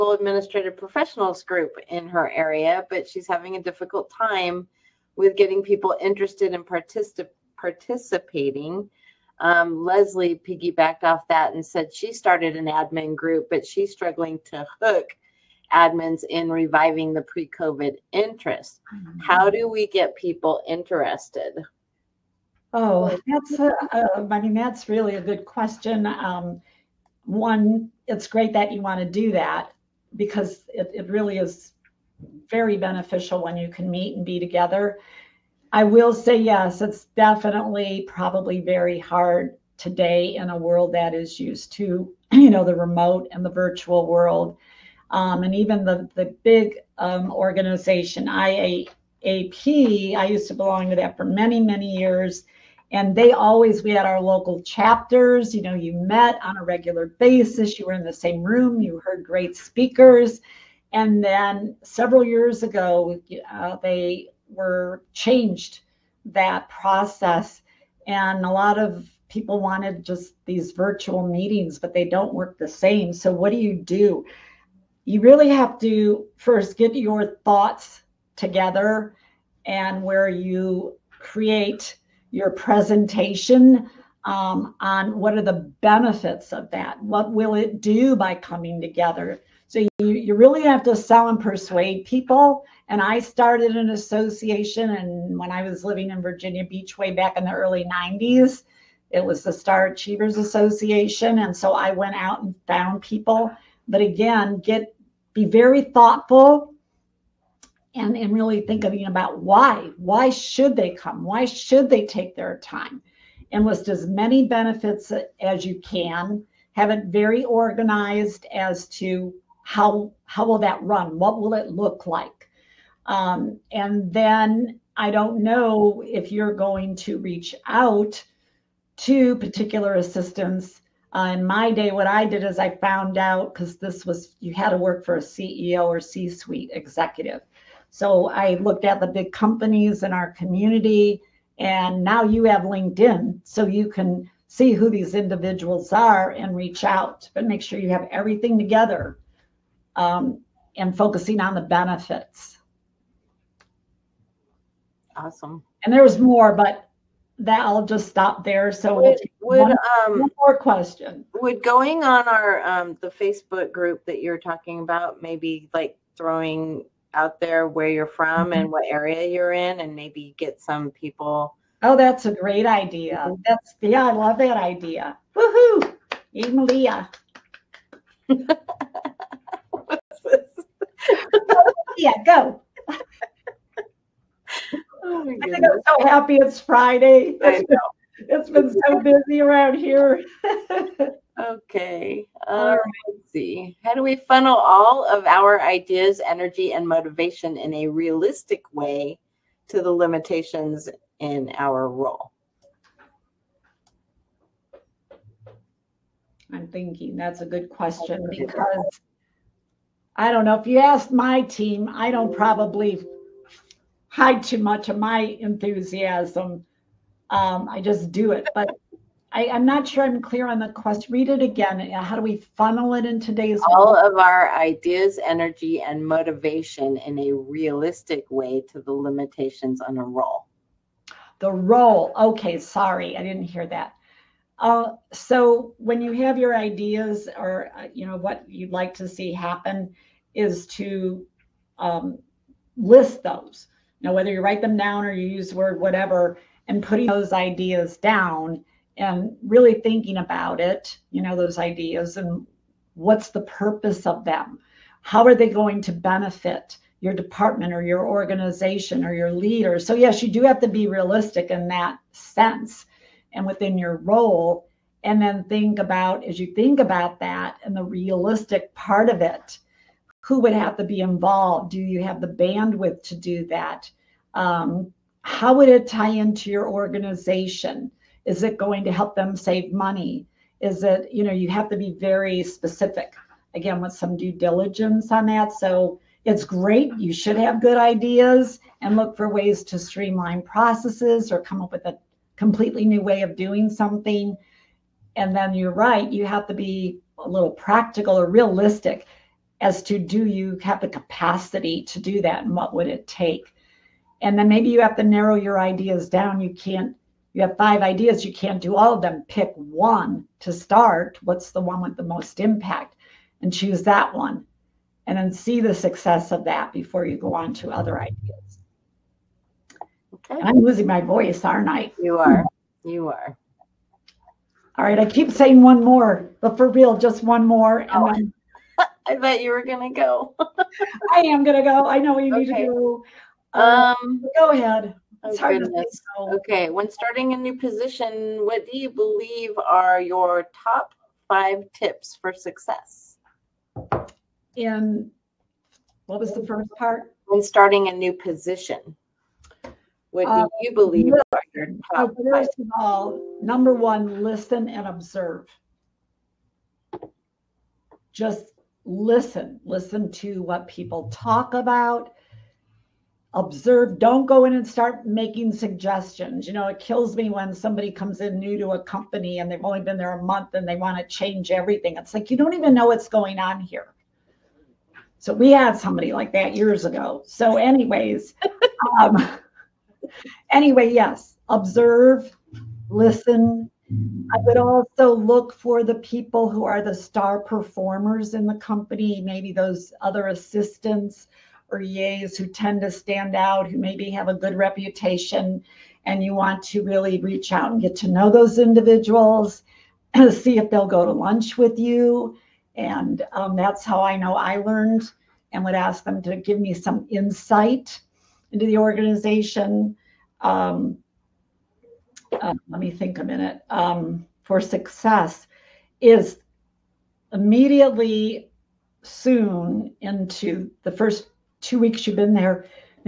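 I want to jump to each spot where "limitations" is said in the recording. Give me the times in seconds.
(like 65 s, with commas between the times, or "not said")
199 s, 228 s.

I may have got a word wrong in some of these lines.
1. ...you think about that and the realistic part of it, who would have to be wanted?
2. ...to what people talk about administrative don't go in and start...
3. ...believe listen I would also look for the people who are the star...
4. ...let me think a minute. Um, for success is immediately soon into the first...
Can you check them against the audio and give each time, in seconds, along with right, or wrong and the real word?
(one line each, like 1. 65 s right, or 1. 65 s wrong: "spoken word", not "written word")
1. 266 s wrong: "involved", not "wanted"
2. 360 s wrong: "observe", not "administrative"
3. 381 s wrong: "observe", not "believe"
4. 412 s right.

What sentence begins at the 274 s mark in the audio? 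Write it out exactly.
Um, how would it tie into your organization?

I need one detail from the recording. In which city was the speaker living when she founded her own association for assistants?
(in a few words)
Virginia Beach.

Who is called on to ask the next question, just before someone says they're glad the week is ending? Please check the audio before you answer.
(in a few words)
Emilia.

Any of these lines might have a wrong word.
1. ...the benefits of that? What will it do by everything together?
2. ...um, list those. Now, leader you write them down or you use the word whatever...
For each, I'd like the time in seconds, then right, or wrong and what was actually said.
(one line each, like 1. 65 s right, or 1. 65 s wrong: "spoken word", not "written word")
1. 85 s wrong: "coming", not "everything"
2. 241 s wrong: "whether", not "leader".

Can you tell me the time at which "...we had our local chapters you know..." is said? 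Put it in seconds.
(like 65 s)
53 s.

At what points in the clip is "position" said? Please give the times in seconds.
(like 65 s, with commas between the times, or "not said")
337 s, 348 s.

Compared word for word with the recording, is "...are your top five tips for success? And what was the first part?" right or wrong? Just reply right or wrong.
right.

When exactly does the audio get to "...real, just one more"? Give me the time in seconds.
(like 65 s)
326 s.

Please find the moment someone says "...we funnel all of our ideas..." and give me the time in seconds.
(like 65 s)
194 s.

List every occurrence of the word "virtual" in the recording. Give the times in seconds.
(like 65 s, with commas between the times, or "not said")
43 s, 70 s.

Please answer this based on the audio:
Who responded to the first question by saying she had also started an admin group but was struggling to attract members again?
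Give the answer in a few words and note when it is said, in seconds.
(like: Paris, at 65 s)
Leslie, at 9 s.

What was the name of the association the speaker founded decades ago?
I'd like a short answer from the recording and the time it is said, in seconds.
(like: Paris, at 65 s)
Star Achievers Association, at 99 s.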